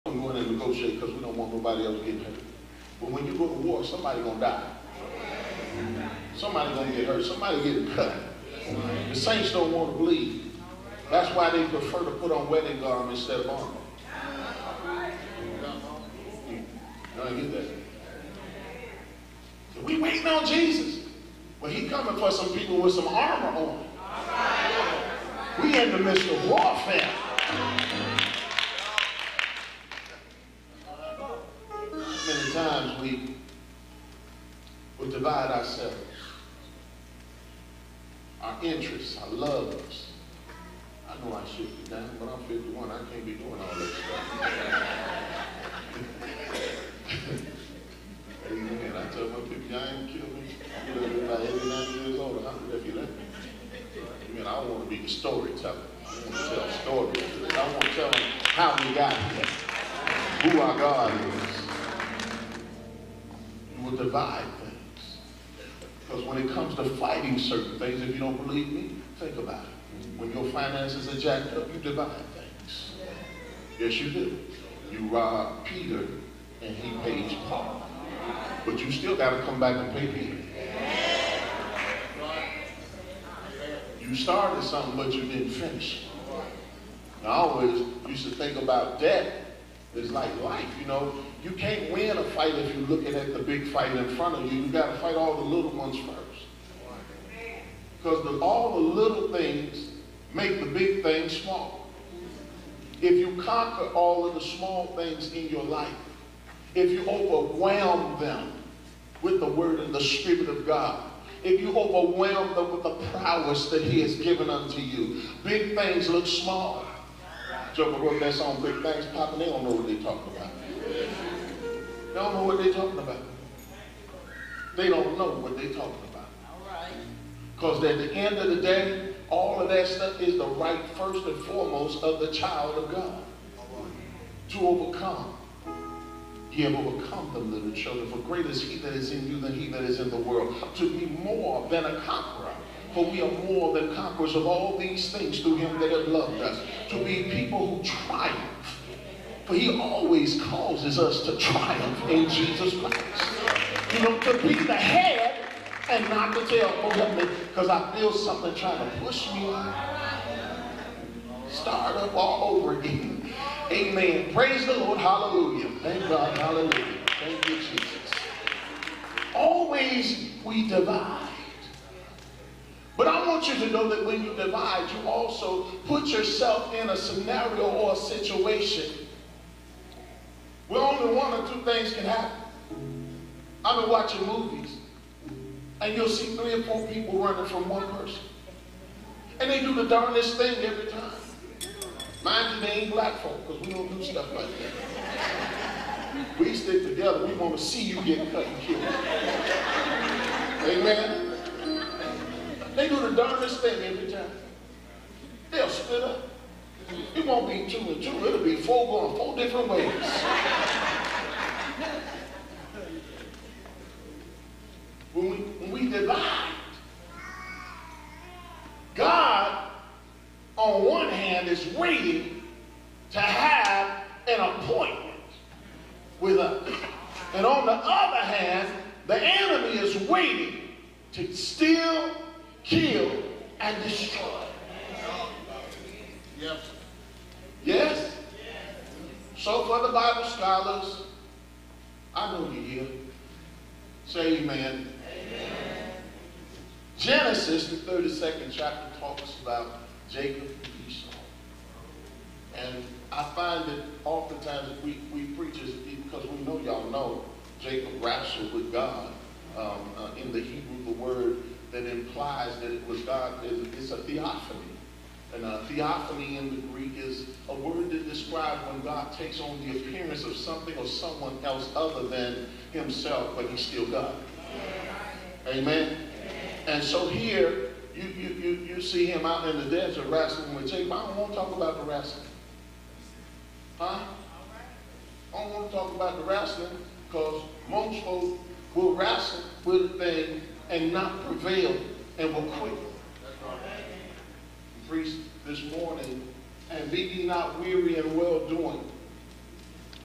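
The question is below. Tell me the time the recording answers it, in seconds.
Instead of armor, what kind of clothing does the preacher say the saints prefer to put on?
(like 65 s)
12 s.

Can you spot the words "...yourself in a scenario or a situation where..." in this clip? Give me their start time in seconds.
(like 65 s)
176 s.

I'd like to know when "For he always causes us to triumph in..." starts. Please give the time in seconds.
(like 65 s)
149 s.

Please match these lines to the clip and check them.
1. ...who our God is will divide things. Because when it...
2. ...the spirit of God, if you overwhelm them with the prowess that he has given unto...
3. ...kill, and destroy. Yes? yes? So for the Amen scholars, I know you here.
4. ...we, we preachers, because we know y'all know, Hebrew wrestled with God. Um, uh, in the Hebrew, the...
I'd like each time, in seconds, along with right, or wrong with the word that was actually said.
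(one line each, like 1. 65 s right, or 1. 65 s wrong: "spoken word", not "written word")
1. 60 s right
2. 109 s right
3. 232 s wrong: "Bible", not "Amen"
4. 254 s wrong: "Jacob", not "Hebrew".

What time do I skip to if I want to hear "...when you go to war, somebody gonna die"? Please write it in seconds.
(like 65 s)
3 s.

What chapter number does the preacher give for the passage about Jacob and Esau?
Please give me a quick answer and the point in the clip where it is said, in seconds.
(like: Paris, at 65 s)
32, at 247 s.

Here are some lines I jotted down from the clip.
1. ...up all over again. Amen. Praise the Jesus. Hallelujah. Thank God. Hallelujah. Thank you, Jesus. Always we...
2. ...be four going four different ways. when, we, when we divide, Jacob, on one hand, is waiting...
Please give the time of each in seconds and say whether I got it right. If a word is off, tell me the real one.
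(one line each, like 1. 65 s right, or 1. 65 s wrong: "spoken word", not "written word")
1. 161 s wrong: "Lord", not "Jesus"
2. 208 s wrong: "God", not "Jacob".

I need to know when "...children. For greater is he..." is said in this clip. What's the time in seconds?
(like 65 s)
137 s.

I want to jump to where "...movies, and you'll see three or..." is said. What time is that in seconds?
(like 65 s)
184 s.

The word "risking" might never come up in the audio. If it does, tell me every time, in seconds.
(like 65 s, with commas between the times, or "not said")
not said.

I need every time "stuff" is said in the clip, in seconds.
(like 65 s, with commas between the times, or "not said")
43 s, 129 s, 194 s.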